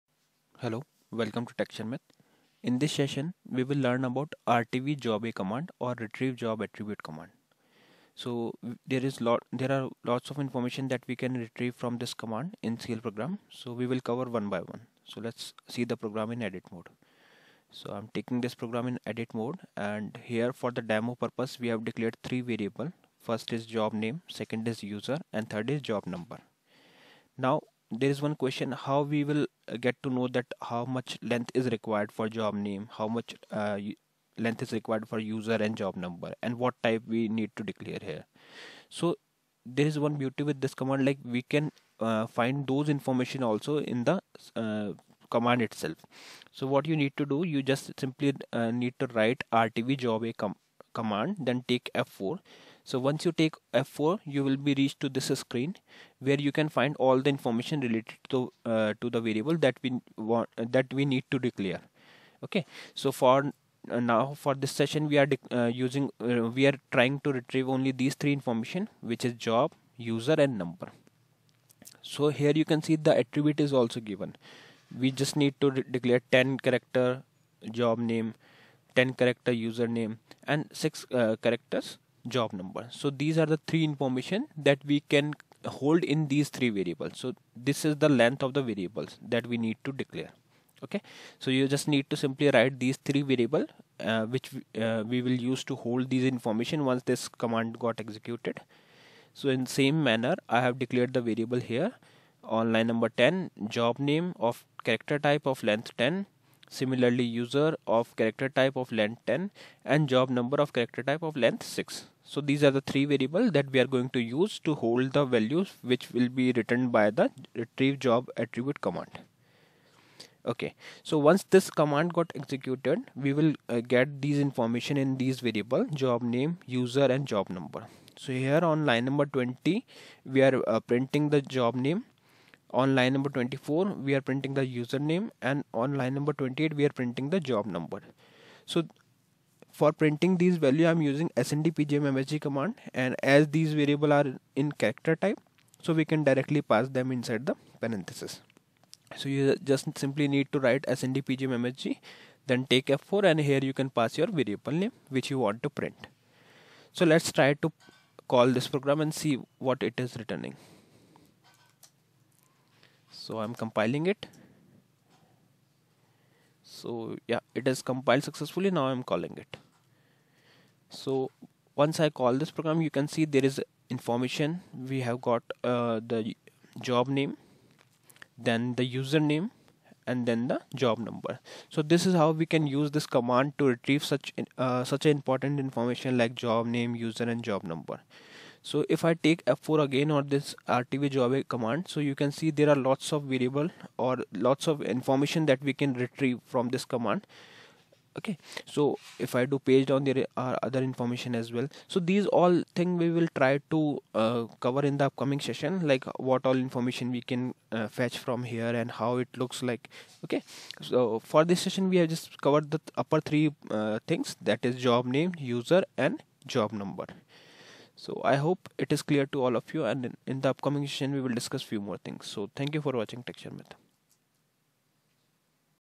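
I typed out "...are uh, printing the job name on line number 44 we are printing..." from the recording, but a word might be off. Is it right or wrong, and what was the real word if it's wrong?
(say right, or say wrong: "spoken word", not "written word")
wrong: "24", not "44".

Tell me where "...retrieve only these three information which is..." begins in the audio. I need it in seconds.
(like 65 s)
67 s.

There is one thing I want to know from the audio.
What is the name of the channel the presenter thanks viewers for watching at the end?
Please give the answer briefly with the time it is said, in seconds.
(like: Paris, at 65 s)
Tech Sharmit, at 223 s.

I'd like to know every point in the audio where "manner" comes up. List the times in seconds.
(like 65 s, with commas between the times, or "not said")
100 s.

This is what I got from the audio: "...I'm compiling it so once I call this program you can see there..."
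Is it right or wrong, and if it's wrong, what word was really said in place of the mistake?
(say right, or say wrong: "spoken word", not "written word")
wrong: "calling", not "compiling".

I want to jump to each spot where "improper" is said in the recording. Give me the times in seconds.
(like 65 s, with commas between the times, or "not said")
not said.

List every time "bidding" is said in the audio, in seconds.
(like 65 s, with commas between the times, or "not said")
not said.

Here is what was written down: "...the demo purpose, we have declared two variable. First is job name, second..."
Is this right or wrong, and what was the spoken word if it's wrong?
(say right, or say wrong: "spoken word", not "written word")
wrong: "three", not "two".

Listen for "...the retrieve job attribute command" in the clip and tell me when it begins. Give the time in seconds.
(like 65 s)
117 s.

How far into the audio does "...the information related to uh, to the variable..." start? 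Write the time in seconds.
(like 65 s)
57 s.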